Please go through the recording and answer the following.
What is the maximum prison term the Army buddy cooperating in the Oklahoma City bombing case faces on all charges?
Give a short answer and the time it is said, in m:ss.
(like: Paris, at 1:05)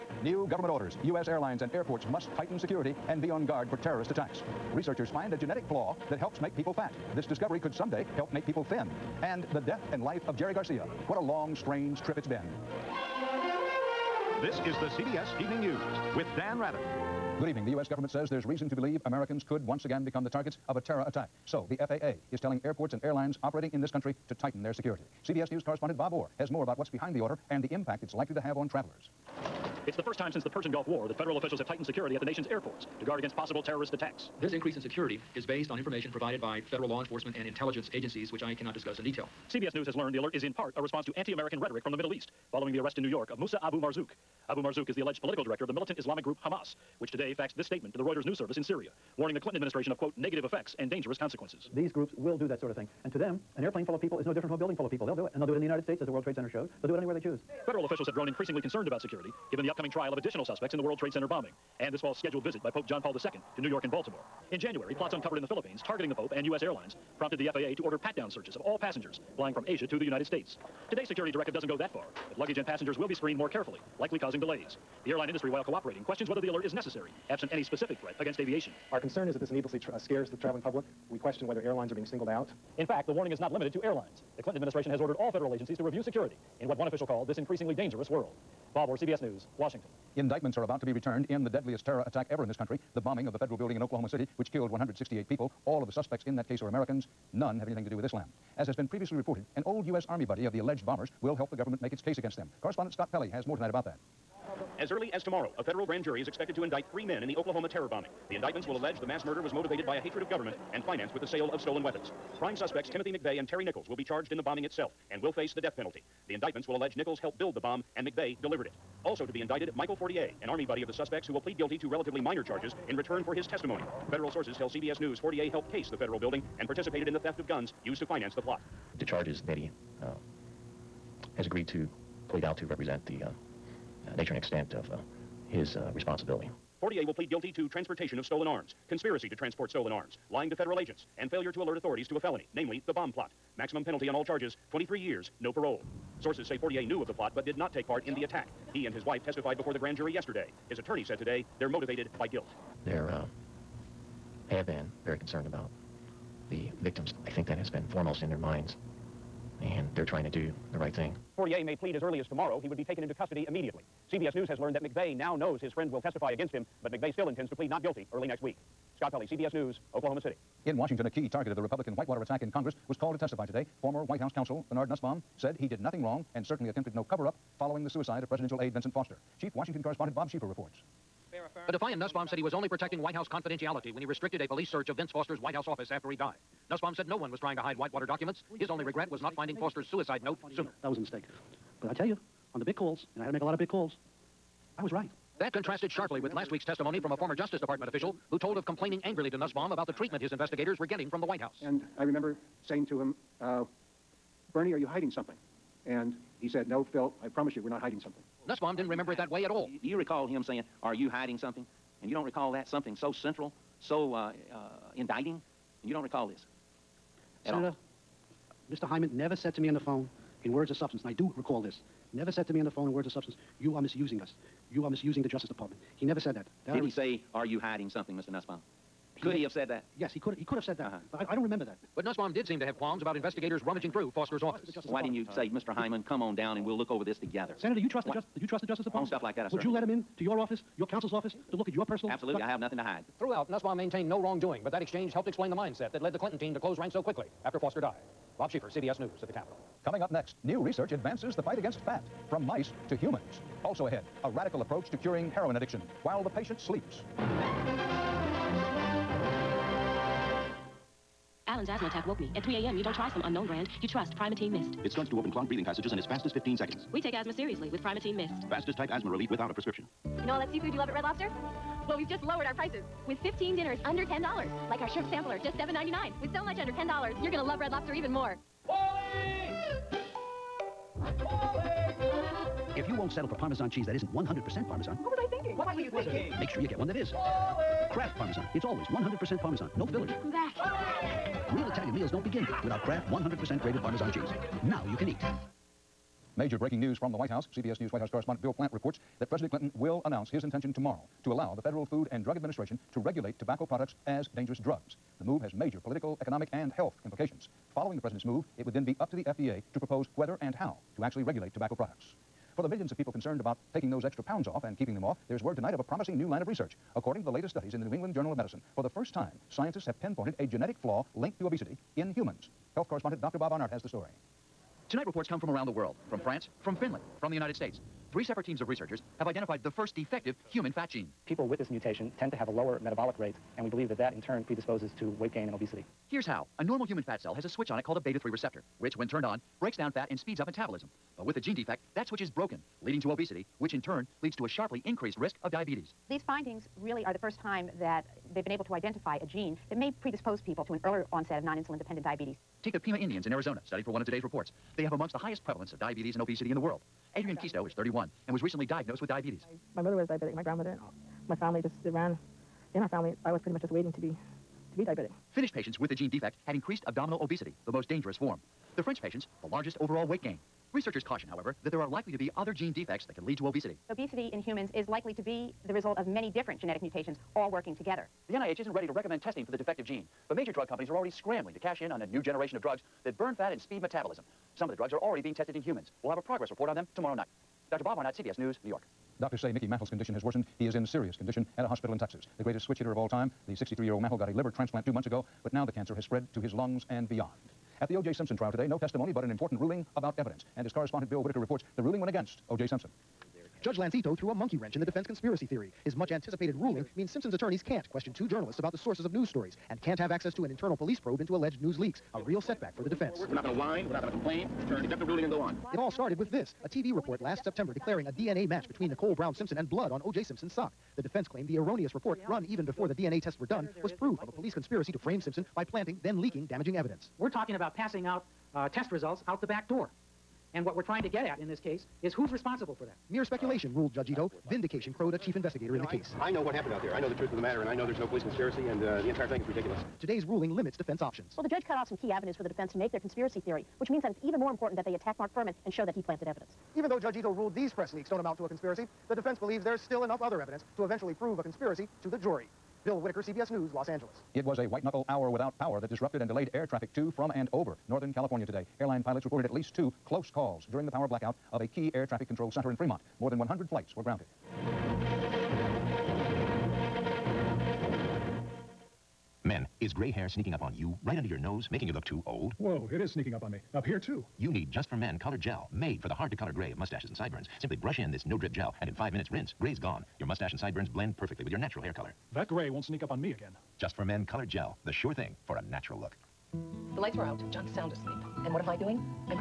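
23 years, at 2:24.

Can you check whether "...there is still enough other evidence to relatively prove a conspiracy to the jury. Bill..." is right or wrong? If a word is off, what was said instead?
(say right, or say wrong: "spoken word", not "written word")
wrong: "eventually", not "relatively".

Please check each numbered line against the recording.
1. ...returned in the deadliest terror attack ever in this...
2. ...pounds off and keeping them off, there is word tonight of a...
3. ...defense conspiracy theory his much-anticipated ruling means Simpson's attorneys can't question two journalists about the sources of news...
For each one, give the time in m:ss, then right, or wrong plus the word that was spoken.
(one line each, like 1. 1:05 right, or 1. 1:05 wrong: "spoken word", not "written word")
1. 1:30 right
2. 5:14 right
3. 6:44 right.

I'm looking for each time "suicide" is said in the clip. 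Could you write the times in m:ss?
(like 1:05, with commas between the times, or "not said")
2:57, 3:09.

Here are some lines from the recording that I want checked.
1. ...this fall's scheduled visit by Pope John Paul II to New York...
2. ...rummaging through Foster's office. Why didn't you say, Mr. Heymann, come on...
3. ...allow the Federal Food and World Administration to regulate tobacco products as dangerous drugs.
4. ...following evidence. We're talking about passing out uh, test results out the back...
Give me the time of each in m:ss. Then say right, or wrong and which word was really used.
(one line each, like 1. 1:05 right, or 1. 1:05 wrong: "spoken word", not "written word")
1. 1:01 right
2. 3:53 right
3. 5:01 wrong: "Drug", not "World"
4. 7:06 wrong: "damaging", not "following".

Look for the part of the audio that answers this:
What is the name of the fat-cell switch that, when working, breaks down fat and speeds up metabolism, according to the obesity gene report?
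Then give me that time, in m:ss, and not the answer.
5:37.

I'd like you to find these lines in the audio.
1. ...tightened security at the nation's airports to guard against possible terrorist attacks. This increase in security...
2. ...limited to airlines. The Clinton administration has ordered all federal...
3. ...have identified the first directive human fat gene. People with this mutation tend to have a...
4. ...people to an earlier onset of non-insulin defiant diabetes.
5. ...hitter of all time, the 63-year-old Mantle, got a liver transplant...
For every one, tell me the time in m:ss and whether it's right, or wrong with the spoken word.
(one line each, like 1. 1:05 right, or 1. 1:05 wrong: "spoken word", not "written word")
1. 0:31 right
2. 1:23 right
3. 5:29 wrong: "defective", not "directive"
4. 5:50 wrong: "dependent", not "defiant"
5. 6:32 right.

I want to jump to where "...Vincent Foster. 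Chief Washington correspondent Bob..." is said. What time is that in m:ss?
2:58.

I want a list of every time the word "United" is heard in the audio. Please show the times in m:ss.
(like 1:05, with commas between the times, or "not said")
0:55, 1:10, 5:27.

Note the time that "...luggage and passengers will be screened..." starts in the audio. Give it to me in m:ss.
1:12.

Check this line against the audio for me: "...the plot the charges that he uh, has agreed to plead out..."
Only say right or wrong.
right.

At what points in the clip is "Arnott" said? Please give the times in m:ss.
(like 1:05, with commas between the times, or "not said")
5:23, 6:27.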